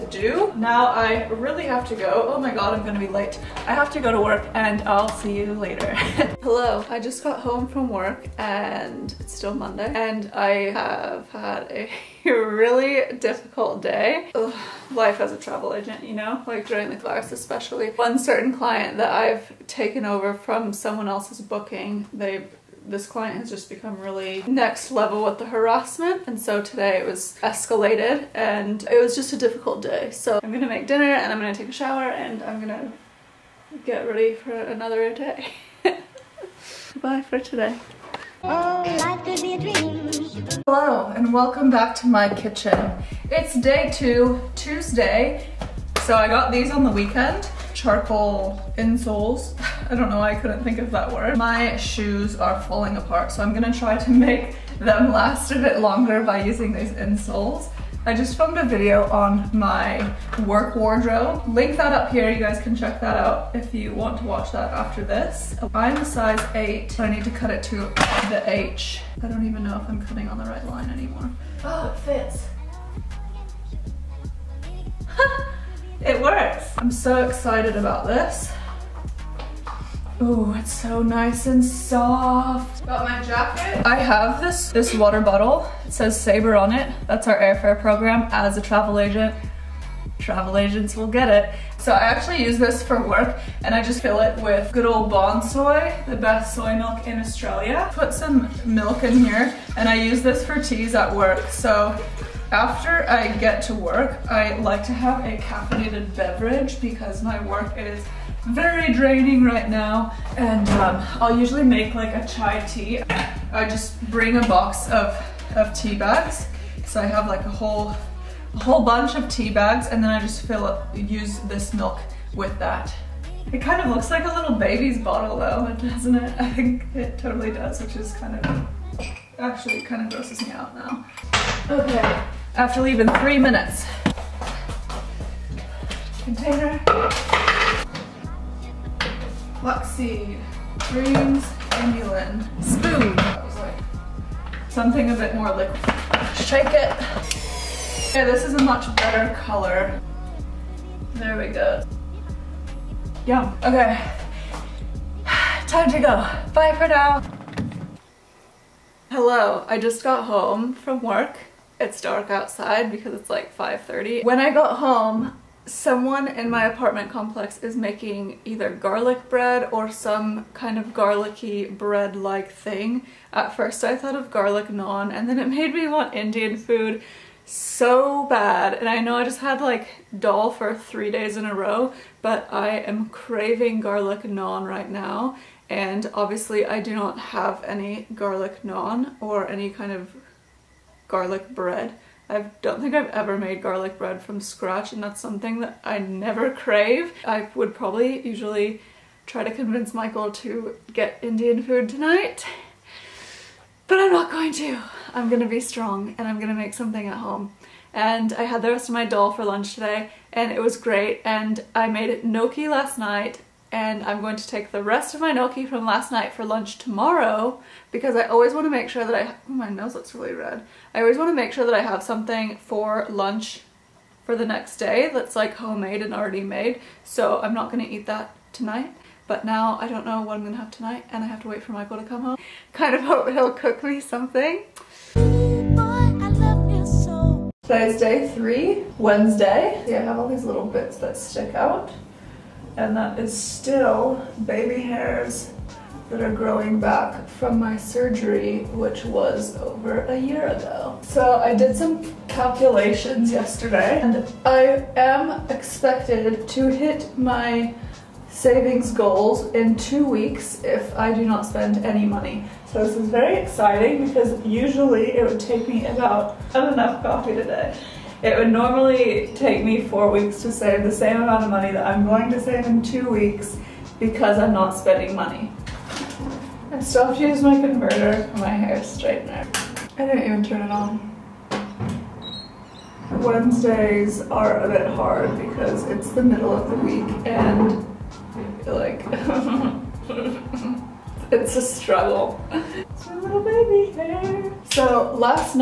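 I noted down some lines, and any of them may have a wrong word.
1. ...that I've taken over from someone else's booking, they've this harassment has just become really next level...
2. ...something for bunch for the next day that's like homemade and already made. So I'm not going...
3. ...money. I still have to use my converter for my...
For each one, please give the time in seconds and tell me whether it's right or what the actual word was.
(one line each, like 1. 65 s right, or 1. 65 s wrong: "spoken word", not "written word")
1. 18 s wrong: "client", not "harassment"
2. 222 s wrong: "lunch", not "bunch"
3. 275 s right.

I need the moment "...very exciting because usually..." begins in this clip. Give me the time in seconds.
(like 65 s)
263 s.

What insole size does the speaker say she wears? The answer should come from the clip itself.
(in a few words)
8.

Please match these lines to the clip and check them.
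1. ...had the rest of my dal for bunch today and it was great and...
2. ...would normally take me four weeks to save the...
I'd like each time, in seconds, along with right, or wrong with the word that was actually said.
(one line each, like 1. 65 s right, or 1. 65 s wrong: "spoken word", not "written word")
1. 208 s wrong: "lunch", not "bunch"
2. 268 s right.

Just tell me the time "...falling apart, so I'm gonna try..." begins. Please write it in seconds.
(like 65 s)
52 s.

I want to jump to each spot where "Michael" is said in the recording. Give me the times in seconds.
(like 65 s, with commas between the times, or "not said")
199 s, 231 s.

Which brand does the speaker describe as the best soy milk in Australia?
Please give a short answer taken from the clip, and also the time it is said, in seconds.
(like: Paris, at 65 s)
Bonsoy, at 95 s.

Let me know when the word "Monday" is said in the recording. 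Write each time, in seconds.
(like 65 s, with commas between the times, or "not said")
9 s.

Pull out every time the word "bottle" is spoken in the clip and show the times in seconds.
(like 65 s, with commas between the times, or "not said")
85 s, 124 s.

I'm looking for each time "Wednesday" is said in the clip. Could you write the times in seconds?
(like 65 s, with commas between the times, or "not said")
238 s, 283 s.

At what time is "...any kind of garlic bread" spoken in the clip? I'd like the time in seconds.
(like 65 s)
189 s.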